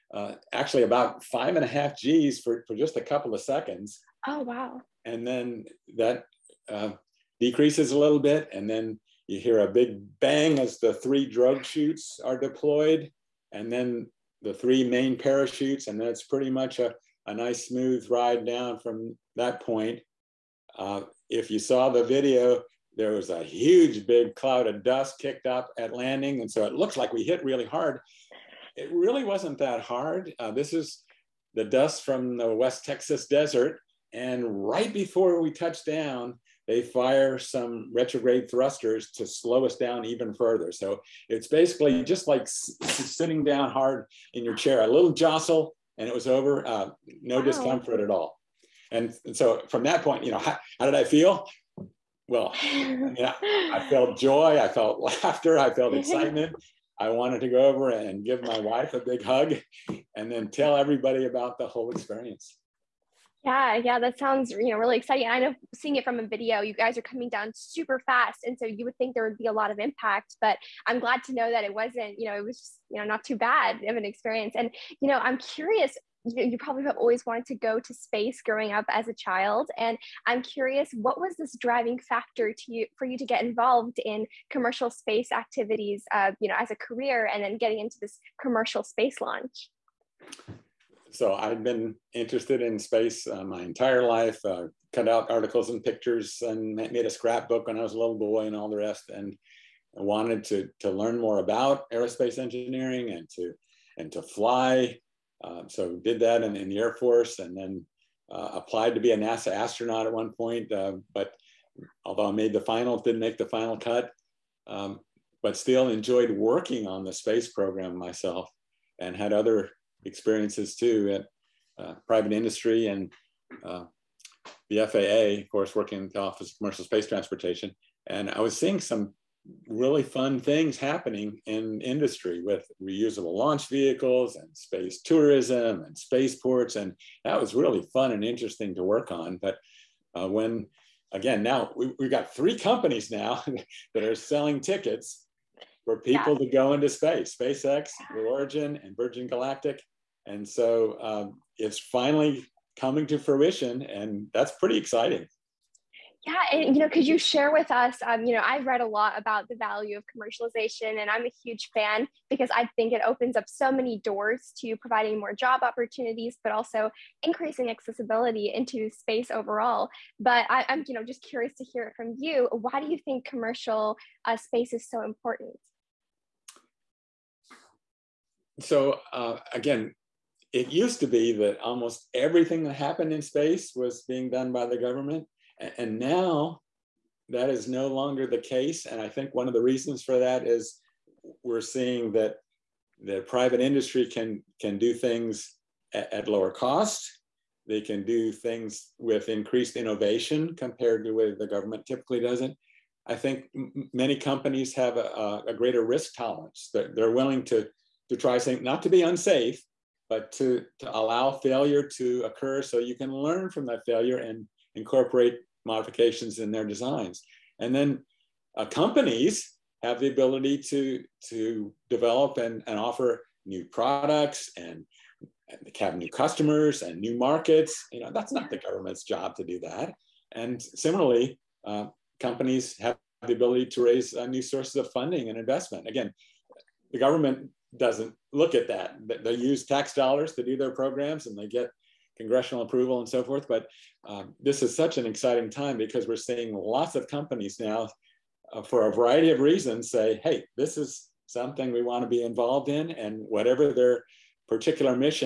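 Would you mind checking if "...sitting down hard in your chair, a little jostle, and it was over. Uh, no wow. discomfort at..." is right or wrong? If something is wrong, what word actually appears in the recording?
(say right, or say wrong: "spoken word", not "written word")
right.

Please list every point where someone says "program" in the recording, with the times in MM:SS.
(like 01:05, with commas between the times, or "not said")
01:57, 04:00.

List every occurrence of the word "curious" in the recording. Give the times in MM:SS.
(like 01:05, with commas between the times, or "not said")
01:15, 01:20, 02:51.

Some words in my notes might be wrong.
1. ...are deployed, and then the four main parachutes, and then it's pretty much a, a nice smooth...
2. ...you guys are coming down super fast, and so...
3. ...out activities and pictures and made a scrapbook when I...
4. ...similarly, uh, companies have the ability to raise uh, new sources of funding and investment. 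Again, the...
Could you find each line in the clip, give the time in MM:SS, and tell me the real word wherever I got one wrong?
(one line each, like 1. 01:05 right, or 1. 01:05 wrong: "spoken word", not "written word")
1. 00:12 wrong: "three", not "four"
2. 01:06 right
3. 01:35 wrong: "articles", not "activities"
4. 03:50 right.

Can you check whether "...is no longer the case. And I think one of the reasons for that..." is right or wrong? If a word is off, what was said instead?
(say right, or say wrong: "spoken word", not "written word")
right.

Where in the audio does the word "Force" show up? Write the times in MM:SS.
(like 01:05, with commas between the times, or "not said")
01:46.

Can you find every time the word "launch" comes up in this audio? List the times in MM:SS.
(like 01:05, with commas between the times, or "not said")
01:29, 02:13.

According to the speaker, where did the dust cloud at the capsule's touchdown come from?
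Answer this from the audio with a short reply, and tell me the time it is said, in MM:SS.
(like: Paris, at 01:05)
West Texas desert, at 00:32.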